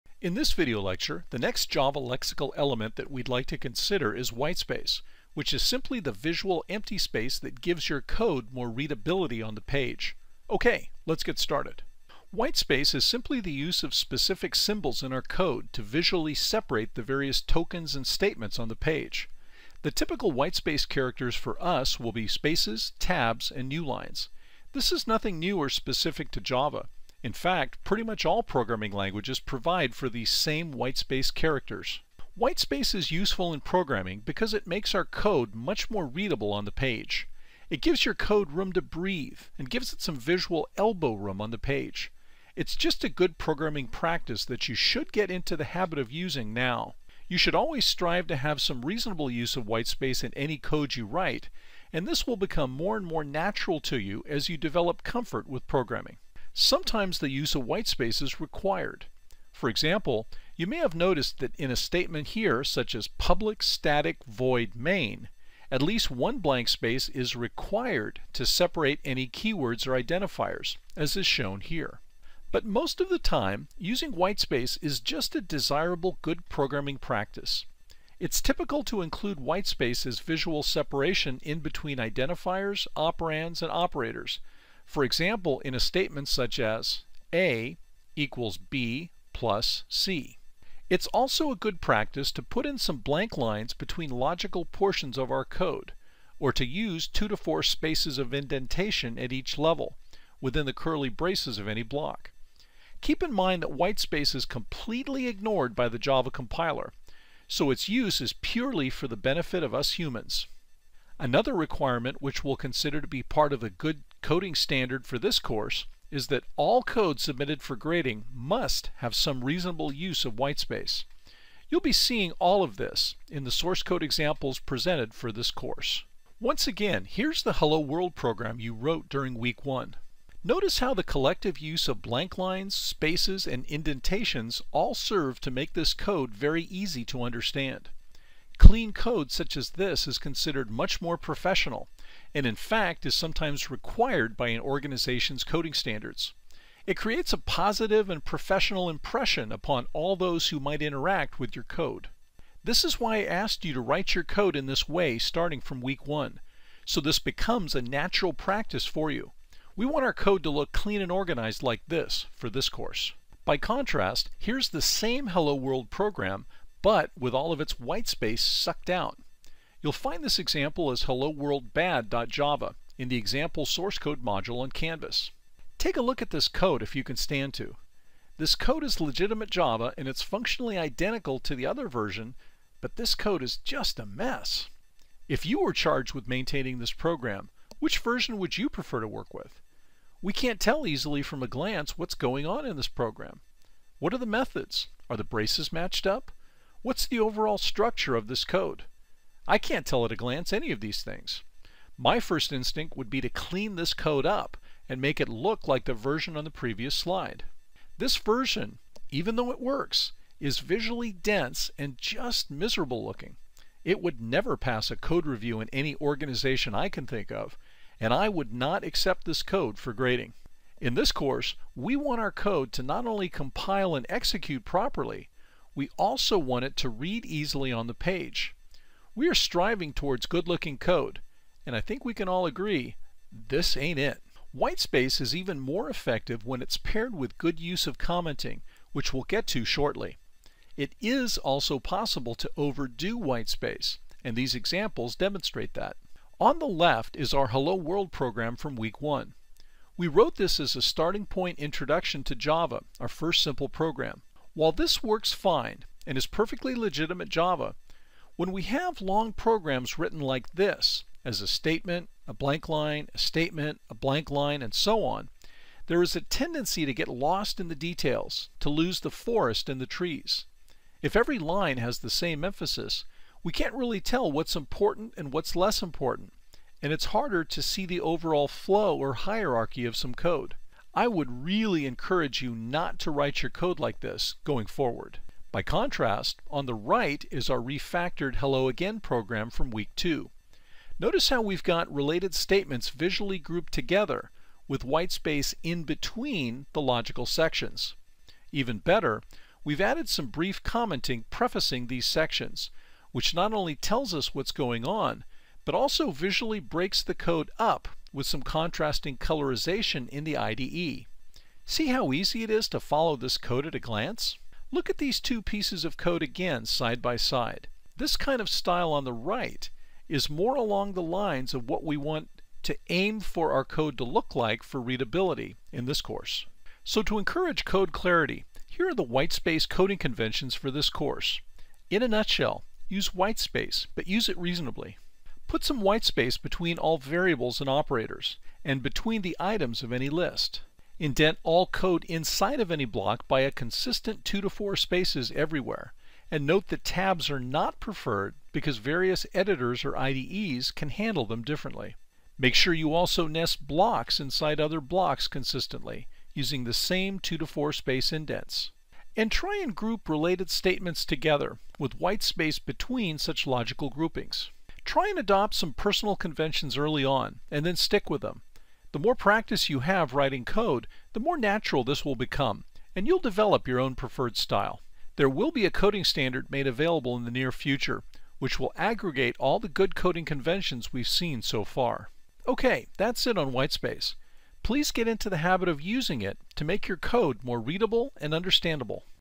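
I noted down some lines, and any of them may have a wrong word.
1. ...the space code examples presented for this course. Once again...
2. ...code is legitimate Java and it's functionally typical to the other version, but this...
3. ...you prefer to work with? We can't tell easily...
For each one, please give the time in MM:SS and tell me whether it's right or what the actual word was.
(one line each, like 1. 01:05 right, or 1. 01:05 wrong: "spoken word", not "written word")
1. 02:03 wrong: "source", not "space"
2. 02:58 wrong: "identical", not "typical"
3. 03:08 right.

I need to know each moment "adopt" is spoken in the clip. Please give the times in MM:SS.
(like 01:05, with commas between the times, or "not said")
06:05.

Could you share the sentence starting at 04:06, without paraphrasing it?
On the left is our Hello World program from week one.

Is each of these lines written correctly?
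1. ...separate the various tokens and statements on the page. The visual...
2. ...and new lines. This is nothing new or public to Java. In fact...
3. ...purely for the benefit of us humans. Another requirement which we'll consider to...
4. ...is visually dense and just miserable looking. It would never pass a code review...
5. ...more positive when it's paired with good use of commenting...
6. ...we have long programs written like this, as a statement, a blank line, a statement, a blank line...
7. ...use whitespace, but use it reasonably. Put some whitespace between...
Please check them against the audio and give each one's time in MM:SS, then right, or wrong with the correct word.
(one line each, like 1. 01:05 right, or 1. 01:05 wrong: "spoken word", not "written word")
1. 00:16 wrong: "typical", not "visual"
2. 00:23 wrong: "specific", not "public"
3. 01:48 right
4. 03:30 right
5. 03:55 wrong: "effective", not "positive"
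6. 04:18 right
7. 05:32 right.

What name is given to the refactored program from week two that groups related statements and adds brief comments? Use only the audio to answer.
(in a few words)
Hello Again.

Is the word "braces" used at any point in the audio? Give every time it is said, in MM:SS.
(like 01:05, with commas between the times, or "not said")
01:41, 03:15.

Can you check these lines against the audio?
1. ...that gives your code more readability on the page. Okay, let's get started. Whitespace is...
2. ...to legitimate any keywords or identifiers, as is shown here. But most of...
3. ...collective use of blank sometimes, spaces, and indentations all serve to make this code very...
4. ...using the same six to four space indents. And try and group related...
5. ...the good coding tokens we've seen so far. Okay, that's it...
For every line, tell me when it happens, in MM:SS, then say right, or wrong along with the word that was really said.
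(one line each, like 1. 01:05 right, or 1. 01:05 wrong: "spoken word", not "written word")
1. 00:07 right
2. 01:08 wrong: "separate", not "legitimate"
3. 02:11 wrong: "lines", not "sometimes"
4. 05:56 wrong: "two", not "six"
5. 06:19 wrong: "conventions", not "tokens".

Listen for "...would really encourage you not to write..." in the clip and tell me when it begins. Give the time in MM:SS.
04:41.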